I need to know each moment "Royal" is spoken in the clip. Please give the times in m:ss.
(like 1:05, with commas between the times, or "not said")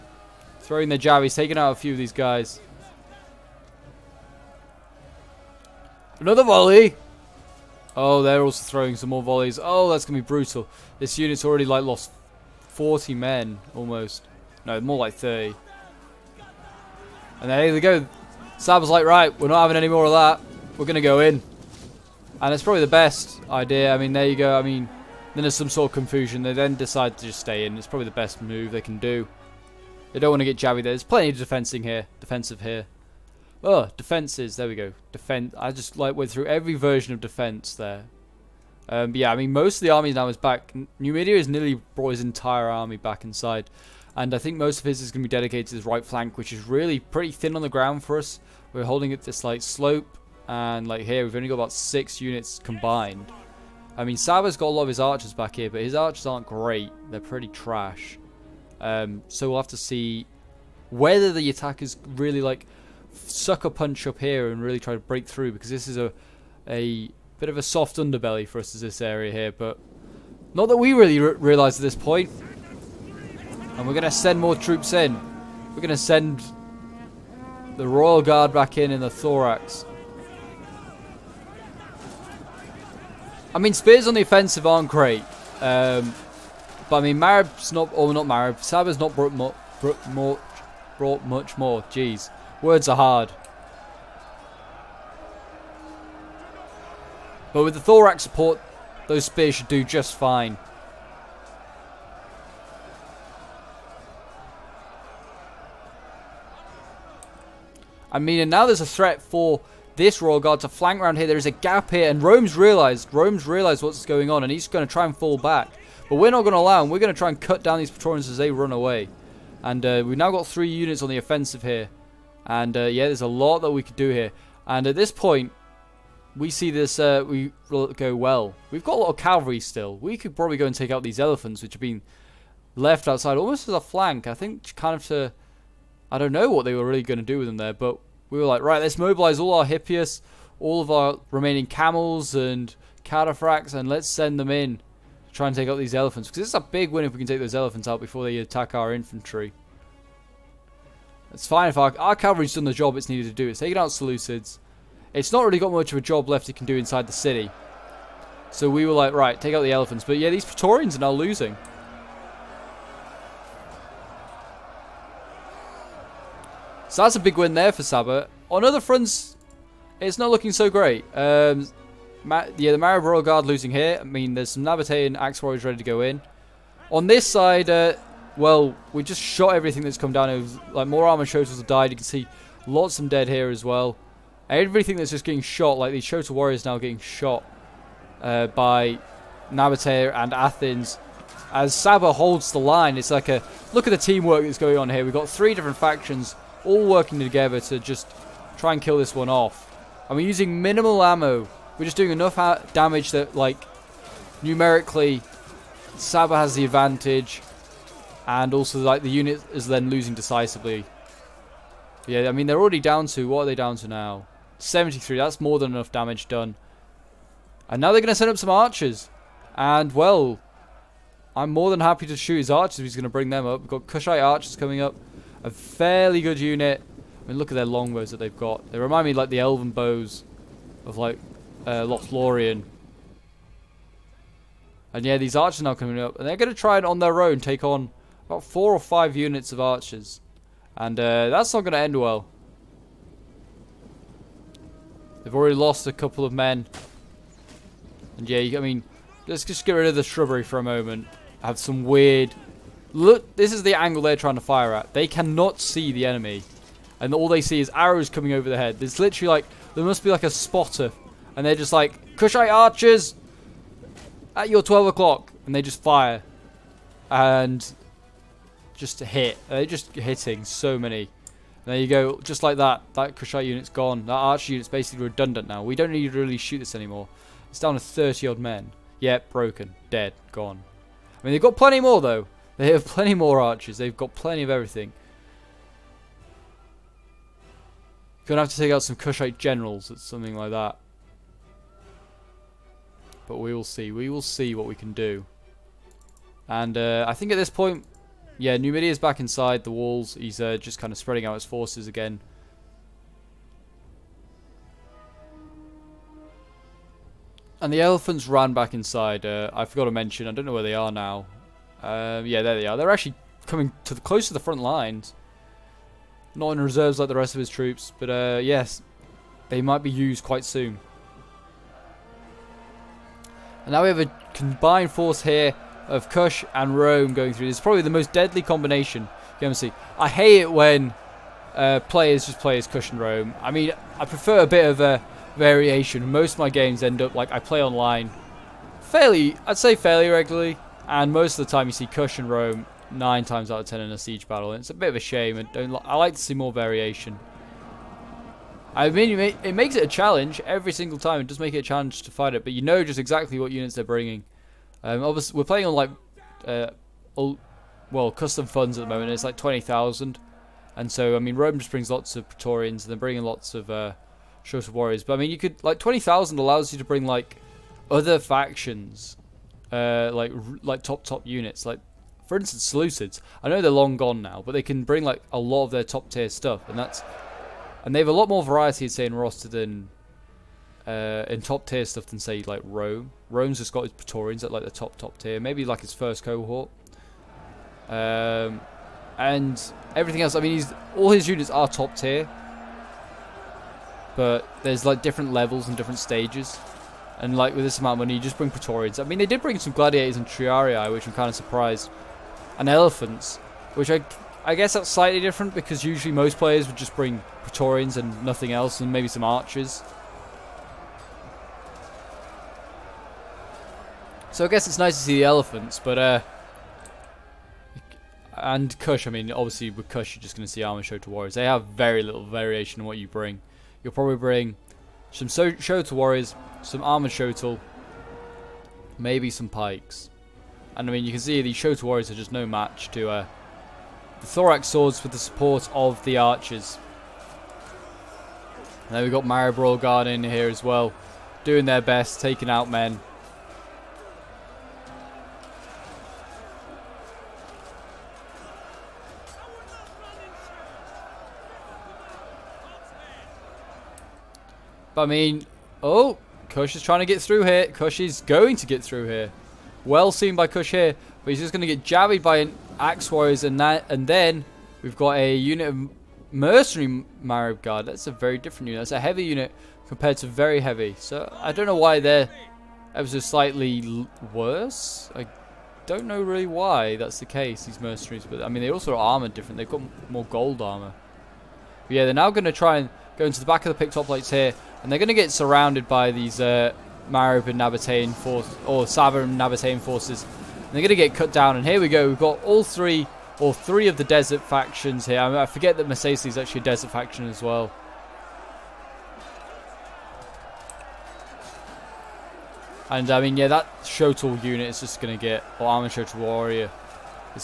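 1:17, 1:50, 2:53.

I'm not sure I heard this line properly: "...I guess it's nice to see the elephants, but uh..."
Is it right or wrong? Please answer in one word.
right.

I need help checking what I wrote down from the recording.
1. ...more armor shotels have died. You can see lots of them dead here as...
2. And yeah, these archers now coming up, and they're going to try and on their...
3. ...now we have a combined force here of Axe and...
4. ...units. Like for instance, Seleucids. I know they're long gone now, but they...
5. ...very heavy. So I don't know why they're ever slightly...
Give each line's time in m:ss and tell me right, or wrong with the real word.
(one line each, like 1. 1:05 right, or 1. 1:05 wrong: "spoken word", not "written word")
1. 3:00 right
2. 3:54 right
3. 5:23 wrong: "Kush", not "Axe"
4. 6:11 right
5. 7:50 right.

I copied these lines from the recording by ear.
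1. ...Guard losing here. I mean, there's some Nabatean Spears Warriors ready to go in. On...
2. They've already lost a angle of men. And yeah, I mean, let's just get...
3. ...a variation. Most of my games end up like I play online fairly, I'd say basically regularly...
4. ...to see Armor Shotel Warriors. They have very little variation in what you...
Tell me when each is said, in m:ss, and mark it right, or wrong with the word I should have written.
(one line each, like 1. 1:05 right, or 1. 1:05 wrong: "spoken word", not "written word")
1. 2:53 wrong: "Axe", not "Spears"
2. 4:05 wrong: "couple", not "angle"
3. 5:34 wrong: "fairly", not "basically"
4. 7:00 right.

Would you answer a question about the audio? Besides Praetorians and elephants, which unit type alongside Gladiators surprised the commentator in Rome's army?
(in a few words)
Triarii.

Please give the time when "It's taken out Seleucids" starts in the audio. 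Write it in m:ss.
2:33.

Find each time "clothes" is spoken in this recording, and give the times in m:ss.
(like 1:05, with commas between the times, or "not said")
not said.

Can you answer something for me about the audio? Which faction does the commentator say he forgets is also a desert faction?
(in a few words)
Masaesyli.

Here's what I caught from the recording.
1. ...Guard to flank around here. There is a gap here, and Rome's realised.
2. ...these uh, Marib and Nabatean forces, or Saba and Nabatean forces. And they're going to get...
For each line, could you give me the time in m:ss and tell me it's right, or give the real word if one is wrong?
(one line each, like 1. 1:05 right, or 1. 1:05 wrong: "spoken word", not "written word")
1. 1:50 right
2. 8:06 right.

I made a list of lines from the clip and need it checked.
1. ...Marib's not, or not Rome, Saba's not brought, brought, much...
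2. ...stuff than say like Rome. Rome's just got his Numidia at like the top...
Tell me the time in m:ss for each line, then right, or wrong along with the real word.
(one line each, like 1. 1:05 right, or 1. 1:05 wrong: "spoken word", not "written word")
1. 1:27 wrong: "Marib", not "Rome"
2. 6:21 wrong: "Praetorians", not "Numidia".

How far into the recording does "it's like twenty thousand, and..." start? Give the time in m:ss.
5:59.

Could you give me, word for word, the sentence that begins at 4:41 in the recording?
I mean, they've got plenty more though.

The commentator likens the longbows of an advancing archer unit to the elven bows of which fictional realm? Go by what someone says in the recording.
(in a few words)
Lothlorien.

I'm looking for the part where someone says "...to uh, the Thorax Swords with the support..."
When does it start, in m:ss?
7:12.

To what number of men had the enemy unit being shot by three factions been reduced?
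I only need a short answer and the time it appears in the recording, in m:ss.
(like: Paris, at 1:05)
73, at 3:34.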